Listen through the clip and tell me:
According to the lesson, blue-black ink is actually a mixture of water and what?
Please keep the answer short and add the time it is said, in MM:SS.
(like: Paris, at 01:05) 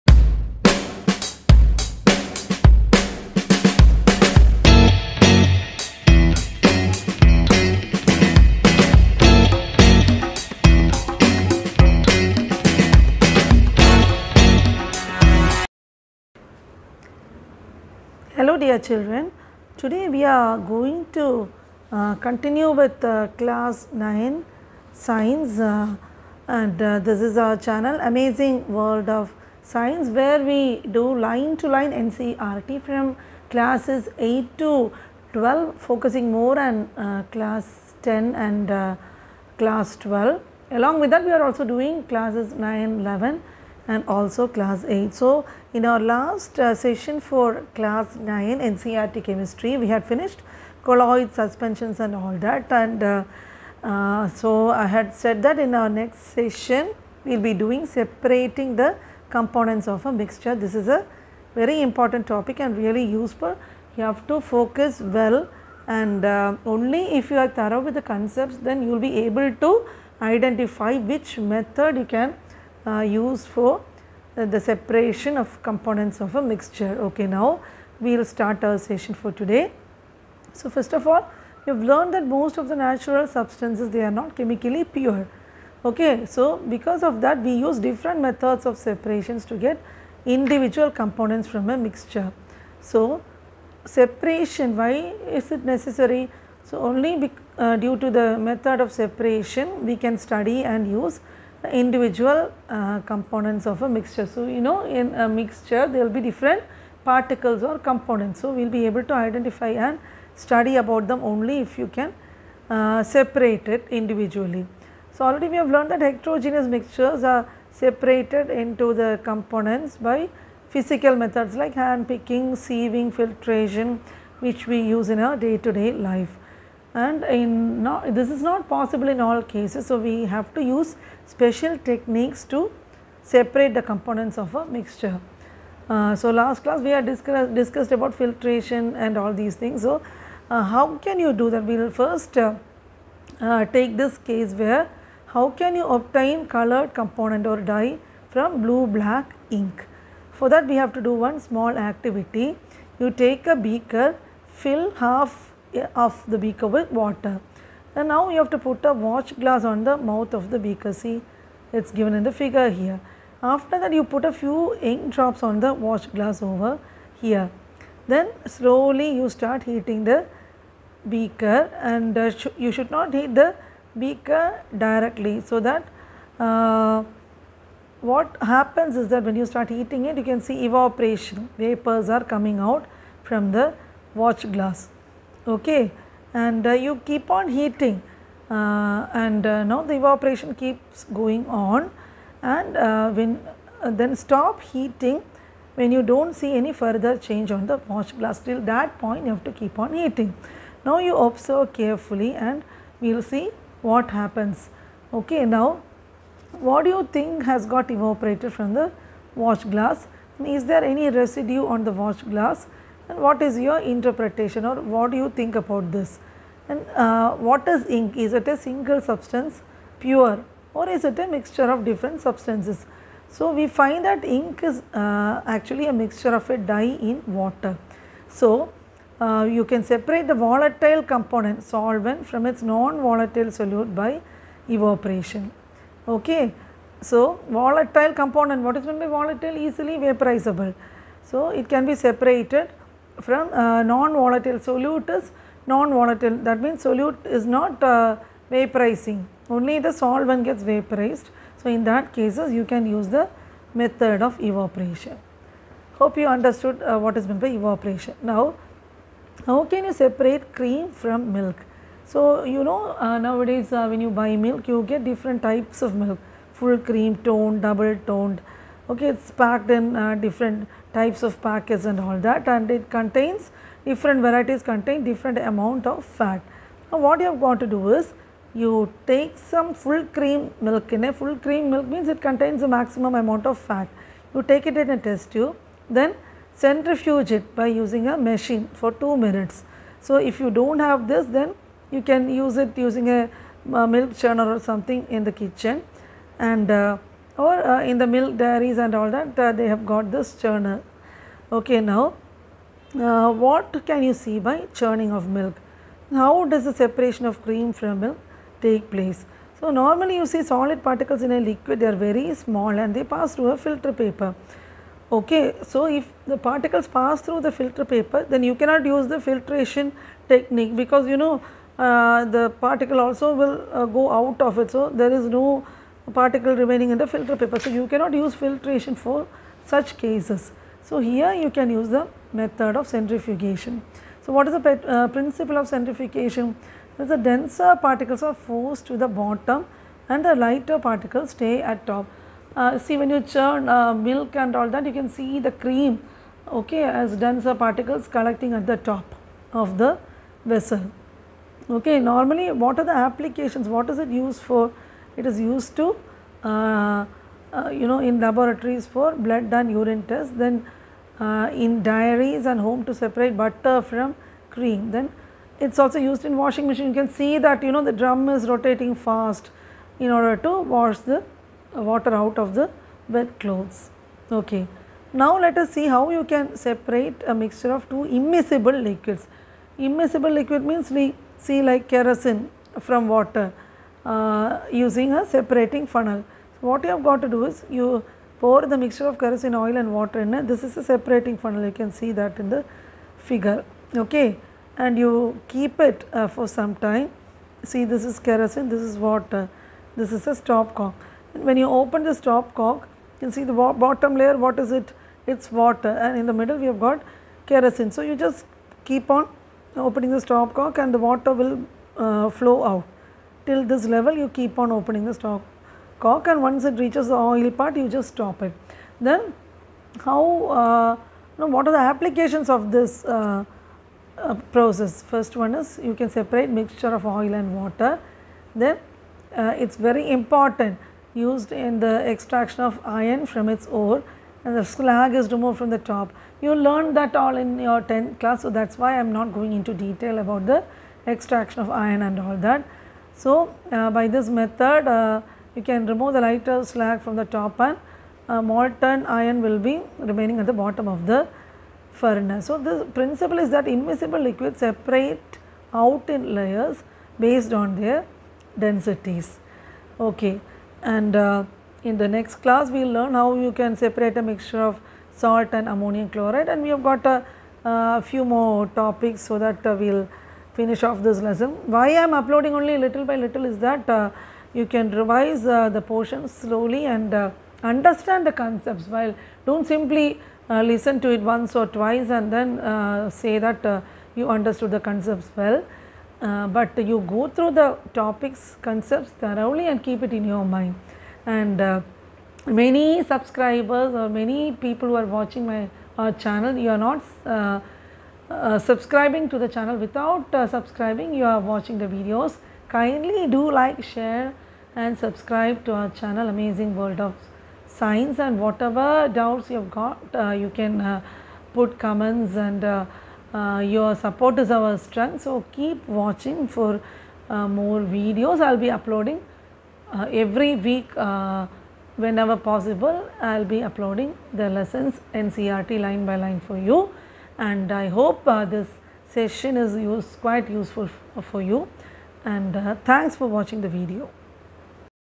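A dye, at 03:46.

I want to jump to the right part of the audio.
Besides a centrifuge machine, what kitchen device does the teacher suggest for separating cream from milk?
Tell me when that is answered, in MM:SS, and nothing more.
04:53.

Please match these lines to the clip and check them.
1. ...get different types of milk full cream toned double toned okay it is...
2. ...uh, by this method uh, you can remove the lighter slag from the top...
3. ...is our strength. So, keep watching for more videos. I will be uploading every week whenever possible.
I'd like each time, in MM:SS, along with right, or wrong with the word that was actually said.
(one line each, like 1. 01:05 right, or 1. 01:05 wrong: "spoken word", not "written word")
1. 04:24 right
2. 07:23 right
3. 08:34 right.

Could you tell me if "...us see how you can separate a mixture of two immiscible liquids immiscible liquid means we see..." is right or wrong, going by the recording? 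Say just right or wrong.
right.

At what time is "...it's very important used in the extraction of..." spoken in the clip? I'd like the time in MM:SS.
07:09.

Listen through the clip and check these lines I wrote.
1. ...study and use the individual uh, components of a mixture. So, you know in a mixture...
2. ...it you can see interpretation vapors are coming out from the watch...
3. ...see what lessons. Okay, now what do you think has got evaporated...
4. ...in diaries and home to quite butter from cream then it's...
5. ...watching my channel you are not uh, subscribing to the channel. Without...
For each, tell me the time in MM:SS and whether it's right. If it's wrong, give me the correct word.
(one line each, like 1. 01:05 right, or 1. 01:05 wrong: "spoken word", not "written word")
1. 01:40 right
2. 03:00 wrong: "evaporation", not "interpretation"
3. 03:23 wrong: "happens", not "lessons"
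4. 06:01 wrong: "separate", not "quite"
5. 08:15 right.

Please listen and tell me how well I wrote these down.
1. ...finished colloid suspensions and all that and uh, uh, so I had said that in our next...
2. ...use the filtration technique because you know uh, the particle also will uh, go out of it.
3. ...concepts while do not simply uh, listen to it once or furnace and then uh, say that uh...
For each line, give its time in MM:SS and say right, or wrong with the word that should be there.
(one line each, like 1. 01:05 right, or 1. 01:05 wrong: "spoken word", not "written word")
1. 00:50 right
2. 05:18 right
3. 07:58 wrong: "twice", not "furnace".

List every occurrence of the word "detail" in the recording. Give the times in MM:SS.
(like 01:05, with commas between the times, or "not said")
07:19.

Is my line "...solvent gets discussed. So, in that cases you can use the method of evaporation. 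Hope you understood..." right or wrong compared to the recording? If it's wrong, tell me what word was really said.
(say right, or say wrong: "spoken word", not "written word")
wrong: "vaporized", not "discussed".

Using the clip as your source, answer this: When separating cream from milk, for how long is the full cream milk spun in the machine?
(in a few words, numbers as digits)
2 minutes.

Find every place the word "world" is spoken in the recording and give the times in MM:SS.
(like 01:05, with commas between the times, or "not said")
00:28, 08:26.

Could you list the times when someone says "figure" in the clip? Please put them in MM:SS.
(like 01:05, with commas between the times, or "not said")
02:42, 06:33.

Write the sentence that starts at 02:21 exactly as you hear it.
We will first uh, uh, take this case where how can you obtain colored component or dye from blue black ink.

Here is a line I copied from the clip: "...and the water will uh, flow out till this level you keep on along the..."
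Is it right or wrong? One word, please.
wrong.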